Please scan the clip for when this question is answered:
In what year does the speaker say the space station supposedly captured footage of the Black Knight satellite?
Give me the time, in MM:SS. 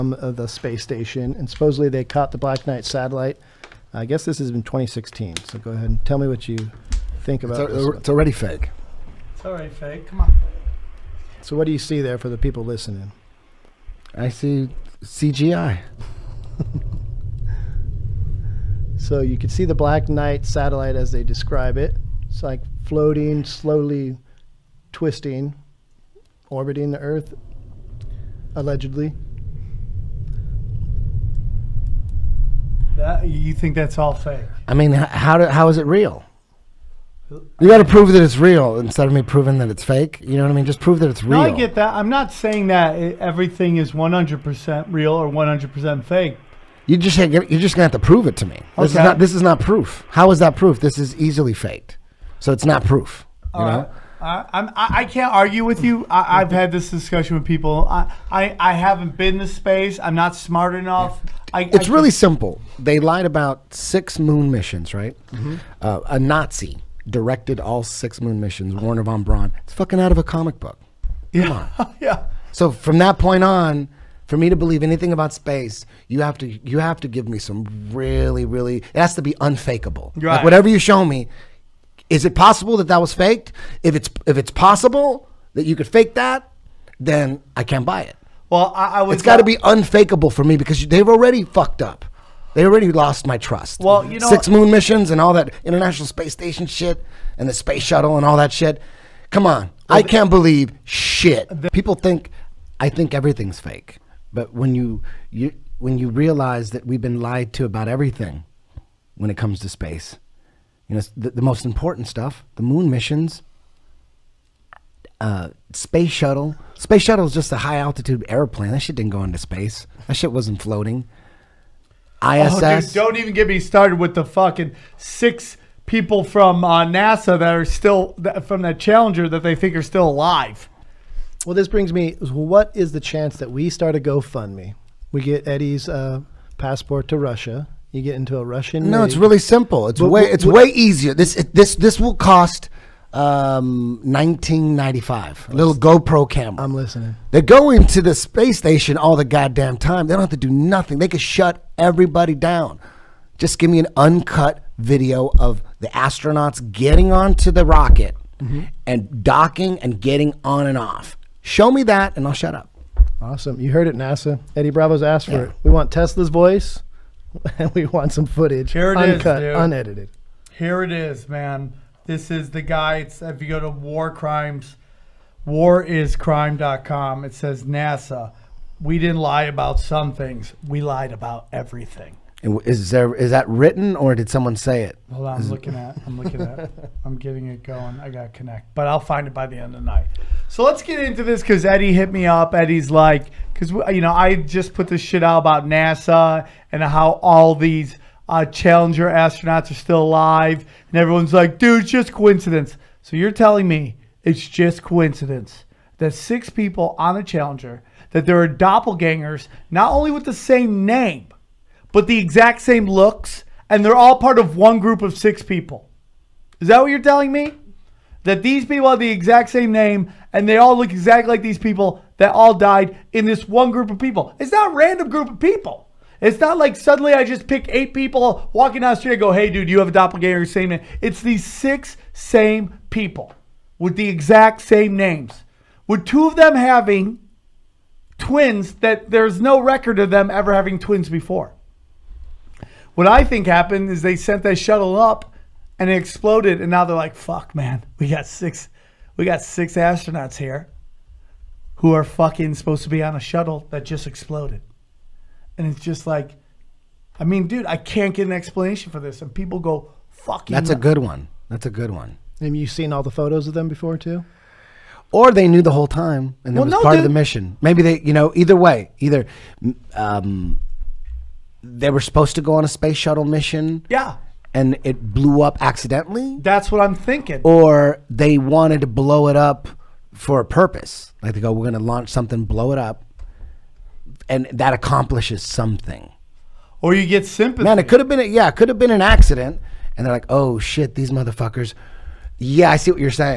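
00:04.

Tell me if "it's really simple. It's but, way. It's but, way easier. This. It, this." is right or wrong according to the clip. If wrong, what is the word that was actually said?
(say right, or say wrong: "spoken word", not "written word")
right.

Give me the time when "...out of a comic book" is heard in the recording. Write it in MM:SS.
01:10.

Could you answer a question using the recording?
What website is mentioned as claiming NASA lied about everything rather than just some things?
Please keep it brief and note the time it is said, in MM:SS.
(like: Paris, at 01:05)
wariscrime.com, at 02:55.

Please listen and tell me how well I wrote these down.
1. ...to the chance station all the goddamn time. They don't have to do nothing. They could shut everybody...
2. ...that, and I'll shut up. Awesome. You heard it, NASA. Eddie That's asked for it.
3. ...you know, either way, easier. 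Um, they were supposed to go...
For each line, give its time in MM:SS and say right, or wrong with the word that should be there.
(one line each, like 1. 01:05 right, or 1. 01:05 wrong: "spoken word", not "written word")
1. 02:27 wrong: "space", not "chance"
2. 02:41 wrong: "Bravo", not "That"
3. 04:28 wrong: "either", not "easier".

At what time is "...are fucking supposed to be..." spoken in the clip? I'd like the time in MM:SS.
04:11.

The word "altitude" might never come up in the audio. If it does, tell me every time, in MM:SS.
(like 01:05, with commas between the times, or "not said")
01:57.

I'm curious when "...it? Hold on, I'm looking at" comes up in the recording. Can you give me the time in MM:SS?
03:04.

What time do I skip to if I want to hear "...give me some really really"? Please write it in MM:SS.
01:17.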